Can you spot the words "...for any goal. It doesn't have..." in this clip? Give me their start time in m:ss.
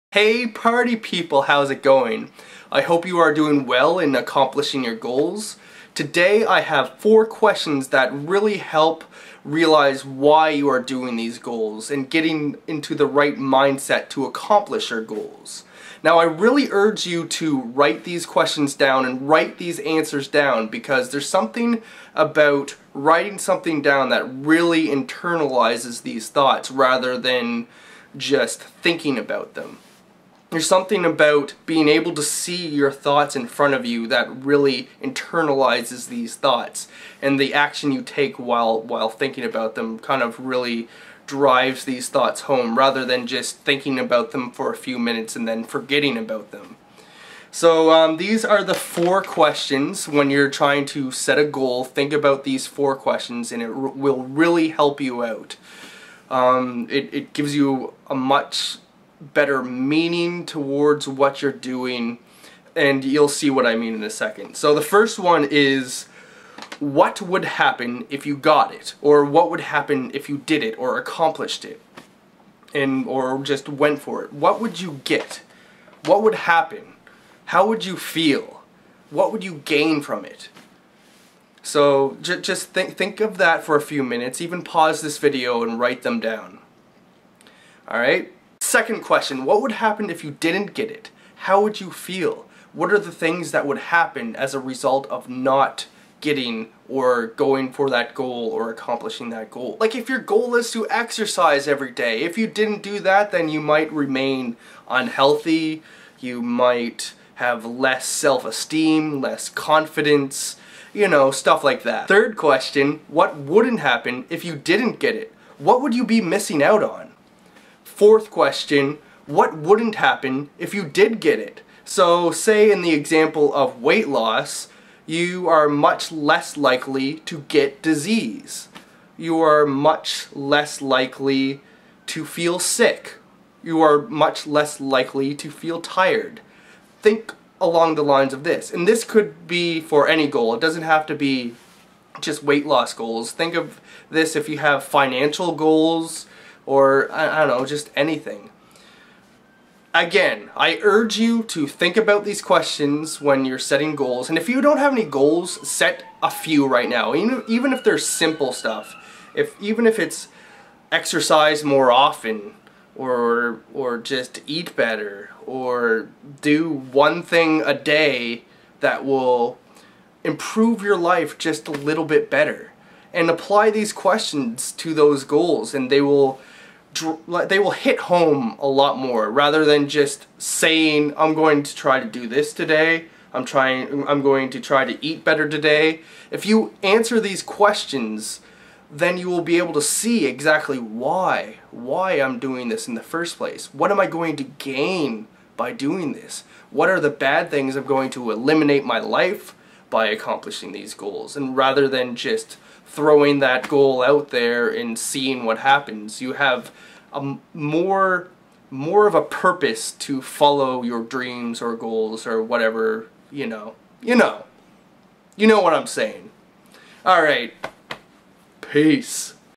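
2:19.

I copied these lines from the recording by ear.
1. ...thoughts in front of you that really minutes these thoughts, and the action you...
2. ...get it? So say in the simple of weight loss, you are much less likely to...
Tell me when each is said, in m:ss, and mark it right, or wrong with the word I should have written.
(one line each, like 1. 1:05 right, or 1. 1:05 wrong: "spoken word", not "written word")
1. 0:32 wrong: "internalizes", not "minutes"
2. 2:01 wrong: "example", not "simple".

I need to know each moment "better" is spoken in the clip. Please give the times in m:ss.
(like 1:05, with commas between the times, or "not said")
0:59, 2:44, 2:52, 3:05.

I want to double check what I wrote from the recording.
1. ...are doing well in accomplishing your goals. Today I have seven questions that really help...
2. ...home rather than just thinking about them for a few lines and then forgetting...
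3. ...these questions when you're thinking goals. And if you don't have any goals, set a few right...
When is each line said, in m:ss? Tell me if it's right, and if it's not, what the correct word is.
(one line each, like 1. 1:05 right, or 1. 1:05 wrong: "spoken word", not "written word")
1. 0:03 wrong: "four", not "seven"
2. 0:42 wrong: "minutes", not "lines"
3. 2:32 wrong: "setting", not "thinking".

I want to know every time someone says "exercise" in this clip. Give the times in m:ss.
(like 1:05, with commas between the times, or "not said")
1:40, 2:40.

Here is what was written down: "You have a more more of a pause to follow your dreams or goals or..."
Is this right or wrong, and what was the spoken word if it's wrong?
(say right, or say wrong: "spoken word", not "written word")
wrong: "purpose", not "pause".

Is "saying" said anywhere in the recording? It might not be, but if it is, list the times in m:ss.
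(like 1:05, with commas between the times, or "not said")
3:00, 3:35.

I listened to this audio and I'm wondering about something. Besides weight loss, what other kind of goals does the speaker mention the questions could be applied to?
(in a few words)
Financial goals.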